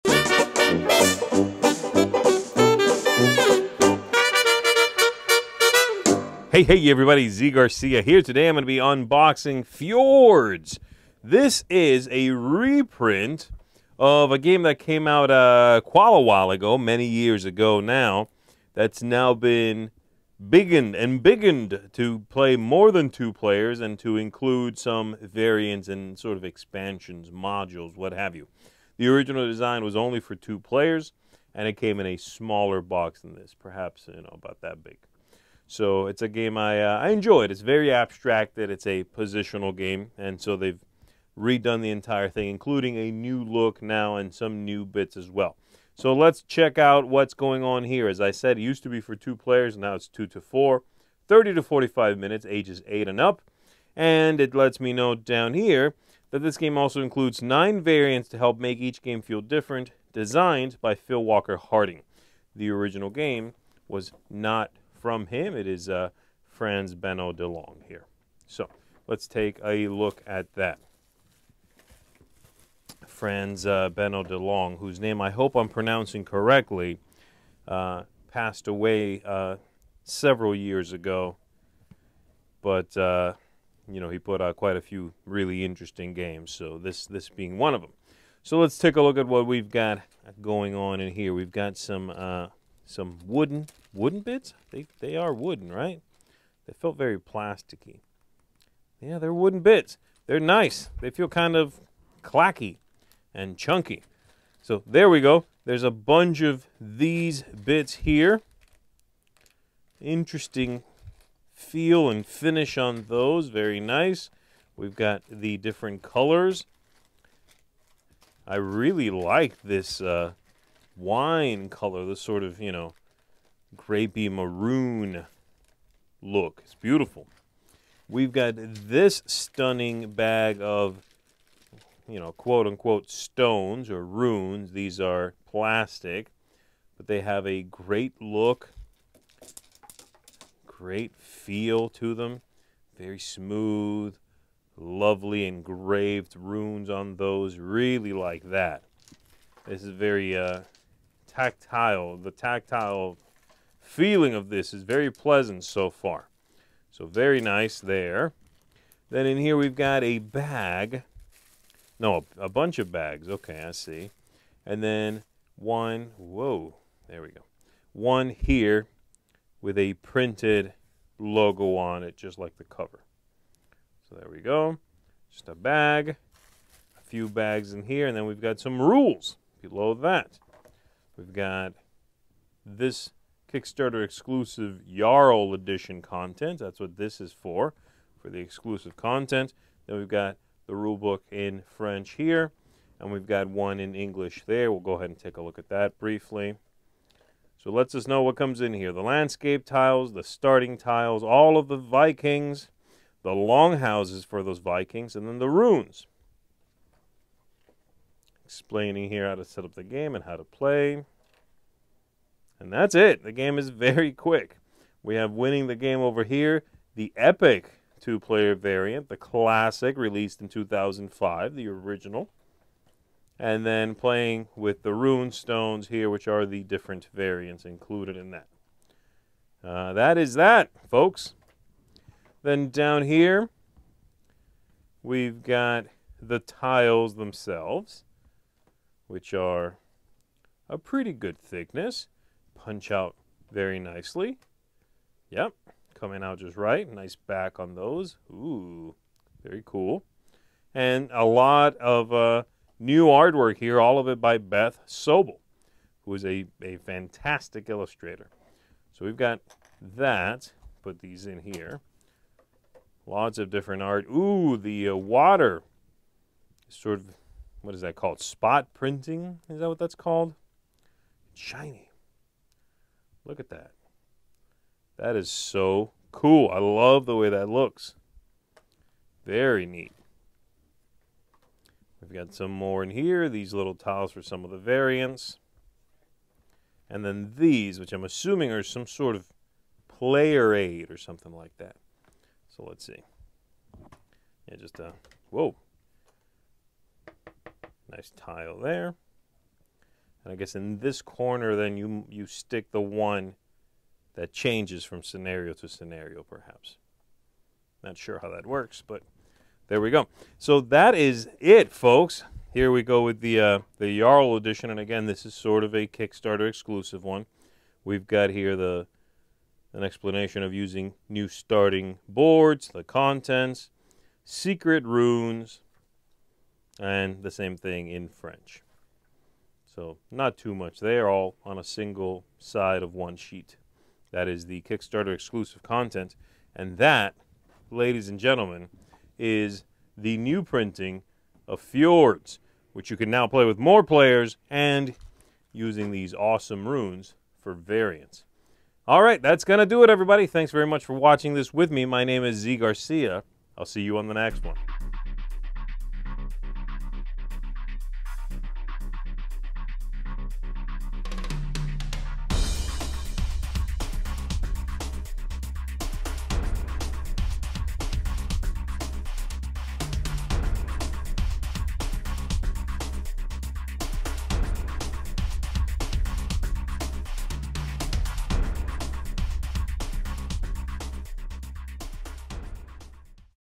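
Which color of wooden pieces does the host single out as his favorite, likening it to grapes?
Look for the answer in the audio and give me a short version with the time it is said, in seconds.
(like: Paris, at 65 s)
wine, at 120 s.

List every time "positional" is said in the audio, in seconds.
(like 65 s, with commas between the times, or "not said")
39 s.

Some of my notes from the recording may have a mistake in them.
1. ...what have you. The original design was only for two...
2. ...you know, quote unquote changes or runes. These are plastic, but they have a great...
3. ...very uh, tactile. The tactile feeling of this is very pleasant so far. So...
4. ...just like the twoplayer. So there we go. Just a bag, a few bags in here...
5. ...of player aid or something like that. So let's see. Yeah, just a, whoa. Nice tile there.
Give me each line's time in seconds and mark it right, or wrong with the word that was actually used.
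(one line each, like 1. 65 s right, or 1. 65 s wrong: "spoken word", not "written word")
1. 27 s right
2. 132 s wrong: "stones", not "changes"
3. 149 s right
4. 172 s wrong: "cover", not "twoplayer"
5. 289 s right.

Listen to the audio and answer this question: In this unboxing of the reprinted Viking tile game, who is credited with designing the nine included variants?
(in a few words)
Phil Walker Harding.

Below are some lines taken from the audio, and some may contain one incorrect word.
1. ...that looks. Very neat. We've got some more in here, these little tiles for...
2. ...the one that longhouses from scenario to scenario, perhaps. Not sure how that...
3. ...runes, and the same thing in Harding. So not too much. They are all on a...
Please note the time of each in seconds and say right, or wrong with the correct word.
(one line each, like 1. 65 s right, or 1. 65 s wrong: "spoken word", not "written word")
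1. 277 s right
2. 302 s wrong: "changes", not "longhouses"
3. 324 s wrong: "French", not "Harding".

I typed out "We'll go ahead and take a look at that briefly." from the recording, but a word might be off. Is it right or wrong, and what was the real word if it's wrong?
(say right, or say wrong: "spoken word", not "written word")
right.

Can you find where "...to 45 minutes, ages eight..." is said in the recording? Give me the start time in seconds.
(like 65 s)
51 s.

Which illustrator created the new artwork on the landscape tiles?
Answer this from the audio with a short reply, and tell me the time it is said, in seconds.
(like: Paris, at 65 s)
Beth Sobel, at 254 s.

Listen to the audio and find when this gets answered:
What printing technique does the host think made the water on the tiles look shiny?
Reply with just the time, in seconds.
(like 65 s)
268 s.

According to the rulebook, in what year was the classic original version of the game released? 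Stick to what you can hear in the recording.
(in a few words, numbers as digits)
2005.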